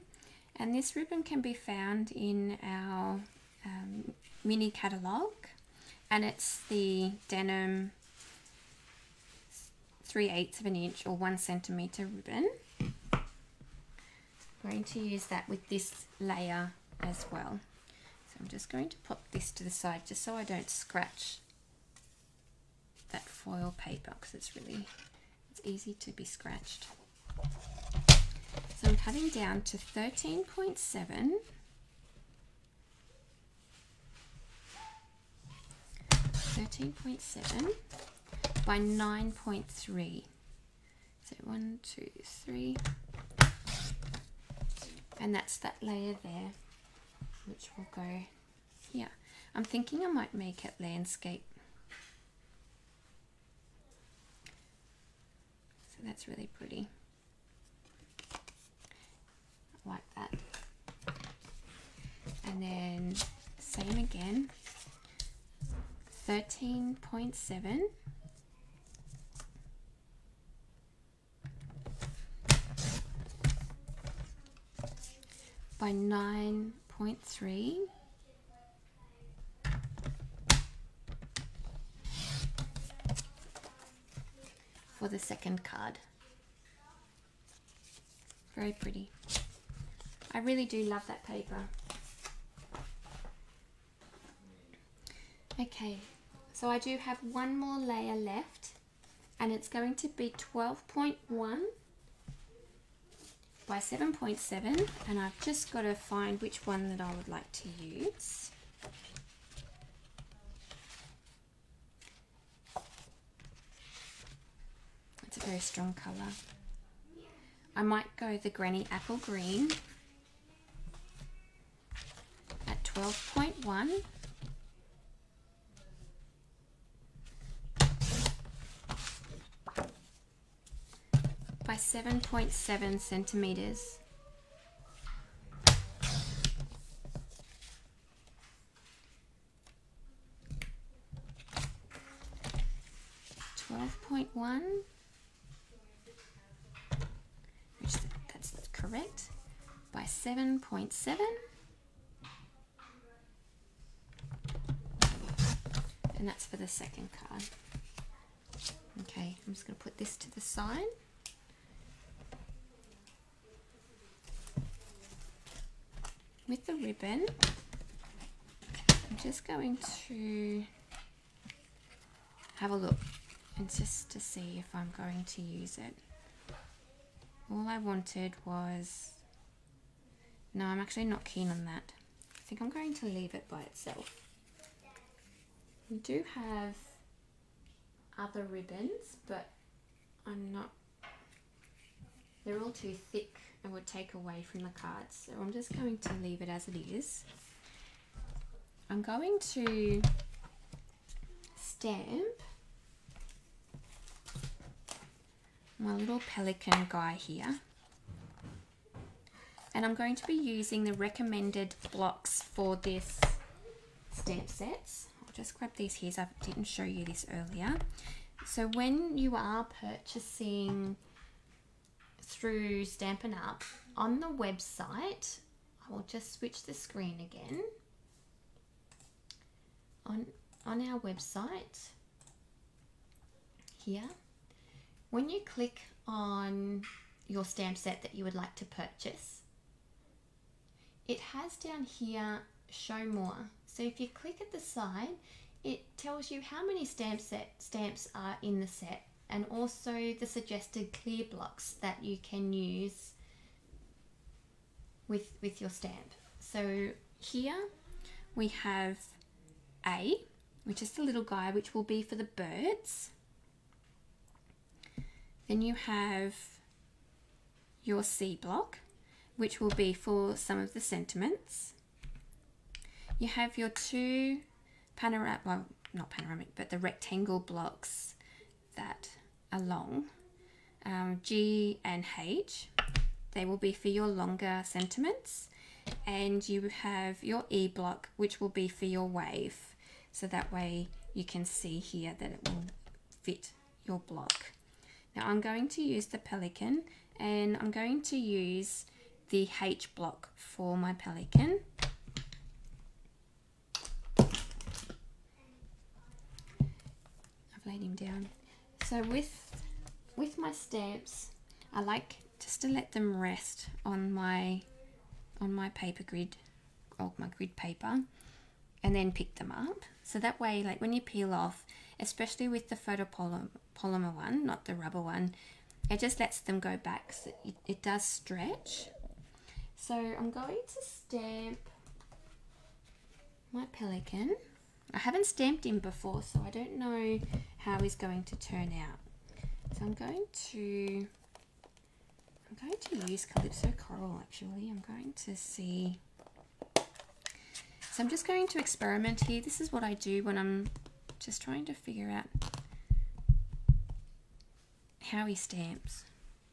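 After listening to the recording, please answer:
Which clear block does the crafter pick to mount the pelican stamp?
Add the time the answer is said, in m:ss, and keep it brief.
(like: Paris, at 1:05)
H block, at 4:59.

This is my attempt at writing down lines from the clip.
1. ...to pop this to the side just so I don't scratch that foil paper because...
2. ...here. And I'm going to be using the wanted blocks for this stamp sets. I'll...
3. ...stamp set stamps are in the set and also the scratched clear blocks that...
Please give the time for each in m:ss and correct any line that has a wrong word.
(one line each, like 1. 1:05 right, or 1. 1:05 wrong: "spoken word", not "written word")
1. 0:18 right
2. 3:27 wrong: "recommended", not "wanted"
3. 4:06 wrong: "suggested", not "scratched".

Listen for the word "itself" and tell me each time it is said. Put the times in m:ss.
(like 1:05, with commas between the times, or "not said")
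3:03.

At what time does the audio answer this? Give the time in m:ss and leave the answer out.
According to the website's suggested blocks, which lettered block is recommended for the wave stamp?
4:47.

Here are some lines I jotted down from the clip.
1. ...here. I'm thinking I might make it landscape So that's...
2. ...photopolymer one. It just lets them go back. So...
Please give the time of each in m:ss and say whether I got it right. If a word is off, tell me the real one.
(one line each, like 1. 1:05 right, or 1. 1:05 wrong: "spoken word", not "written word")
1. 0:48 right
2. 5:24 wrong: "rubber", not "photopolymer".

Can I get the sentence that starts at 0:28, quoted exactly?
So I'm cutting down to 13.7.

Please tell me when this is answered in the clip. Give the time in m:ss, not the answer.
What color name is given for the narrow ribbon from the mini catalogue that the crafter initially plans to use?
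0:07.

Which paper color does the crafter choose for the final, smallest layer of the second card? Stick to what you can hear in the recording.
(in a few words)
Granny Apple Green.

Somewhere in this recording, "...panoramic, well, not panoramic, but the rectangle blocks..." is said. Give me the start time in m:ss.
4:34.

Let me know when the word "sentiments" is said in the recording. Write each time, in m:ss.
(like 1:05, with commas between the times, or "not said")
4:30, 4:44.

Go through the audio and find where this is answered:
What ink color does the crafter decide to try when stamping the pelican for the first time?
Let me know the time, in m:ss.
5:43.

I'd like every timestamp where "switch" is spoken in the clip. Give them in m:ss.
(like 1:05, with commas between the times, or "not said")
3:46.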